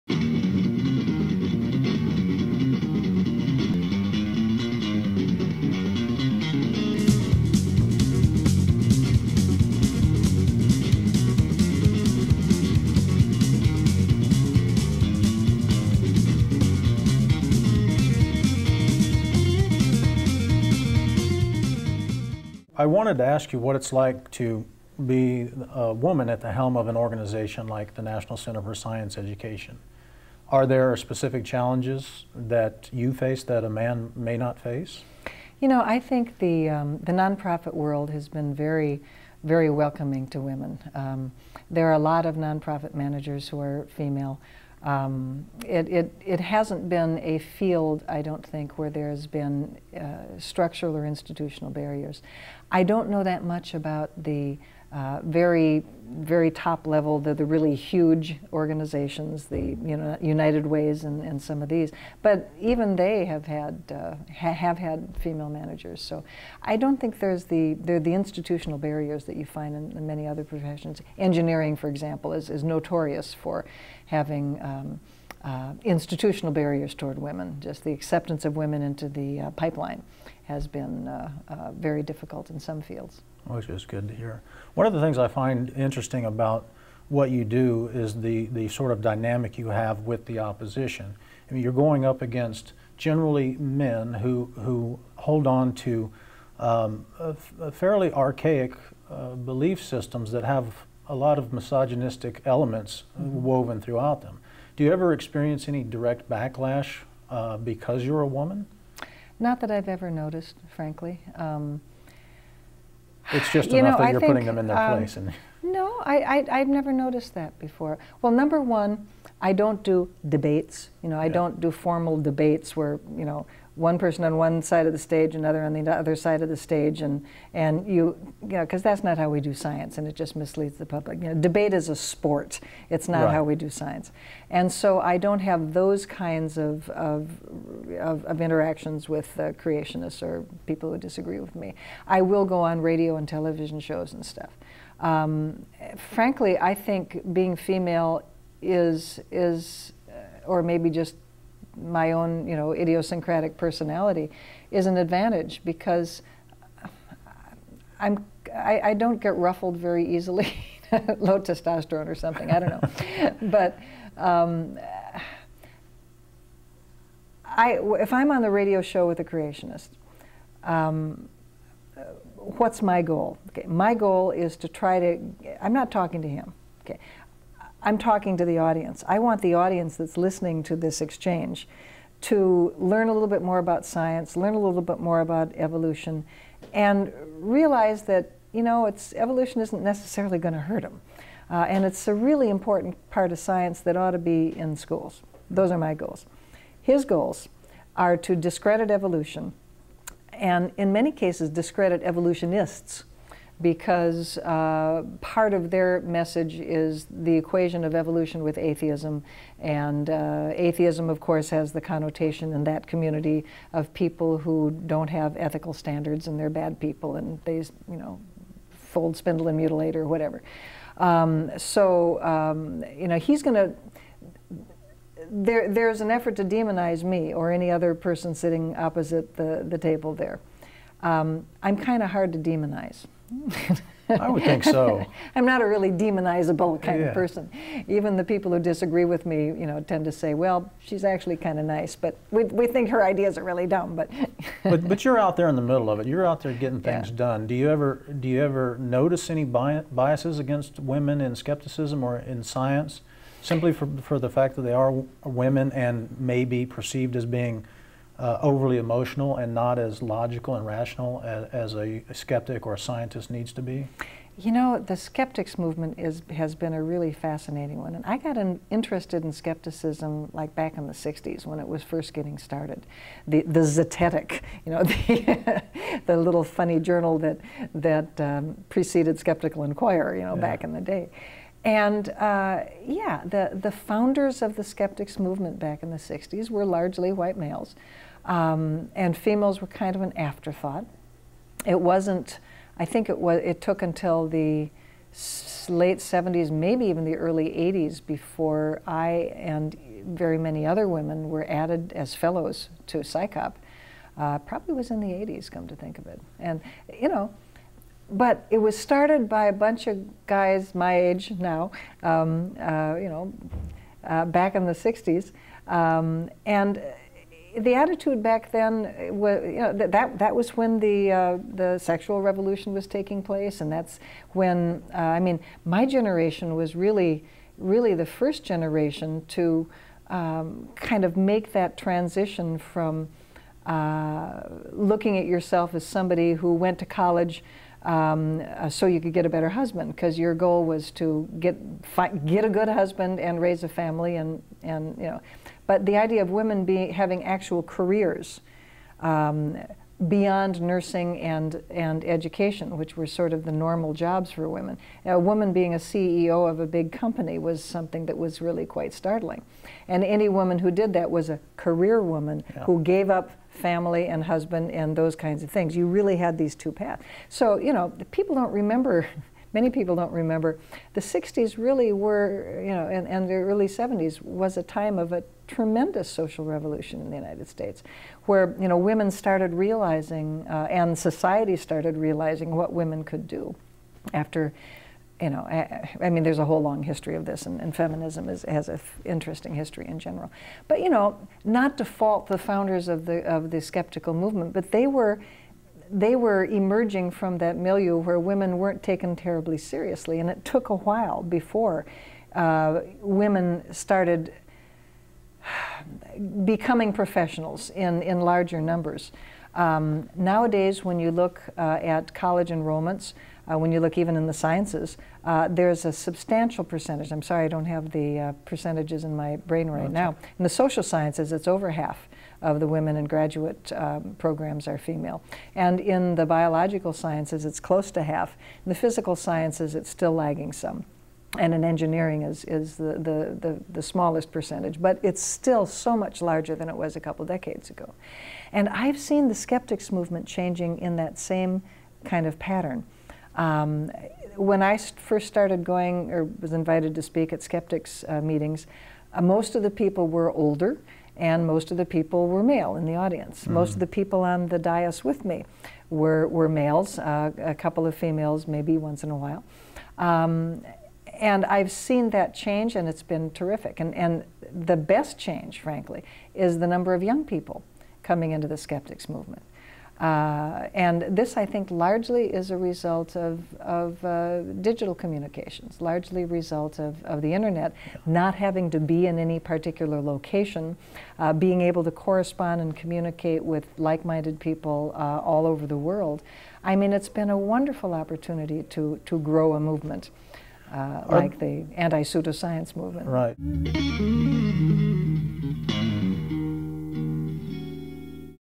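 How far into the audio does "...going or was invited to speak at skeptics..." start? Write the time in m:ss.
7:25.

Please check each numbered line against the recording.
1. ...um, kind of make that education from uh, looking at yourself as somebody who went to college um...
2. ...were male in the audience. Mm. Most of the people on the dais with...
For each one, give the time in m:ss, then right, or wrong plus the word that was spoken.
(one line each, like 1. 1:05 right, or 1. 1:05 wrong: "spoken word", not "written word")
1. 5:30 wrong: "transition", not "education"
2. 7:32 right.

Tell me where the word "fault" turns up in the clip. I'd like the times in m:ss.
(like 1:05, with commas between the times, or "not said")
6:31.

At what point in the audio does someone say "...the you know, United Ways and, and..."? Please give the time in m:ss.
0:59.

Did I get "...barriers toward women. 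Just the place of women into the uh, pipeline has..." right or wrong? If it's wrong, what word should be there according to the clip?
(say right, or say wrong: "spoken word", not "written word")
wrong: "acceptance", not "place".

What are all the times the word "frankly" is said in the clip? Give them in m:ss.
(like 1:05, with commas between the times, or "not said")
1:50, 2:26, 7:45.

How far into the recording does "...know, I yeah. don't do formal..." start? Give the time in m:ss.
2:01.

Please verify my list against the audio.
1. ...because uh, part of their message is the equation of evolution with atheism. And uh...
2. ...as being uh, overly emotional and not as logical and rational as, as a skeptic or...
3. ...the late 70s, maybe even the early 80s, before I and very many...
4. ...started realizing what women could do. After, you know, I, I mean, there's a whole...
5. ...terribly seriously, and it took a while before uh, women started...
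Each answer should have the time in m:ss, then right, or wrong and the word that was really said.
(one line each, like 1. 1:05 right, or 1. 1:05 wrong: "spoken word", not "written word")
1. 3:23 right
2. 4:17 right
3. 4:54 right
4. 6:21 right
5. 6:39 right.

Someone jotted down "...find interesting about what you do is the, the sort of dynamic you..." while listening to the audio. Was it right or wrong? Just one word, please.
right.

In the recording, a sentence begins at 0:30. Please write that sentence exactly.
Are there specific challenges that you face that a man may not face?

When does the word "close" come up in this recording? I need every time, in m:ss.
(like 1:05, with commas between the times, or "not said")
7:07.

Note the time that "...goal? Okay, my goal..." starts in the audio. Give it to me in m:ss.
2:53.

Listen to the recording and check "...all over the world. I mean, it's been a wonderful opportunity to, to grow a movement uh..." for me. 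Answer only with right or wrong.
right.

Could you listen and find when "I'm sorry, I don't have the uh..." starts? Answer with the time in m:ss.
6:57.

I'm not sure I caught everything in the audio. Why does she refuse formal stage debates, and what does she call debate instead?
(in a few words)
a sport.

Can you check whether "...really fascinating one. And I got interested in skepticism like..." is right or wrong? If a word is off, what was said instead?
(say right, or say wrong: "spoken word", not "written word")
right.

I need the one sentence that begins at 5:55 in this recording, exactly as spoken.
Now, a woman being a CEO of a big company was something that was really quite startling.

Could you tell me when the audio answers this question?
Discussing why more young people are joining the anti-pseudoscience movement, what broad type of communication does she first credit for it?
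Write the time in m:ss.
7:54.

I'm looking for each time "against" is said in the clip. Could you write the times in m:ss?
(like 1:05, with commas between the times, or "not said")
1:32, 4:10.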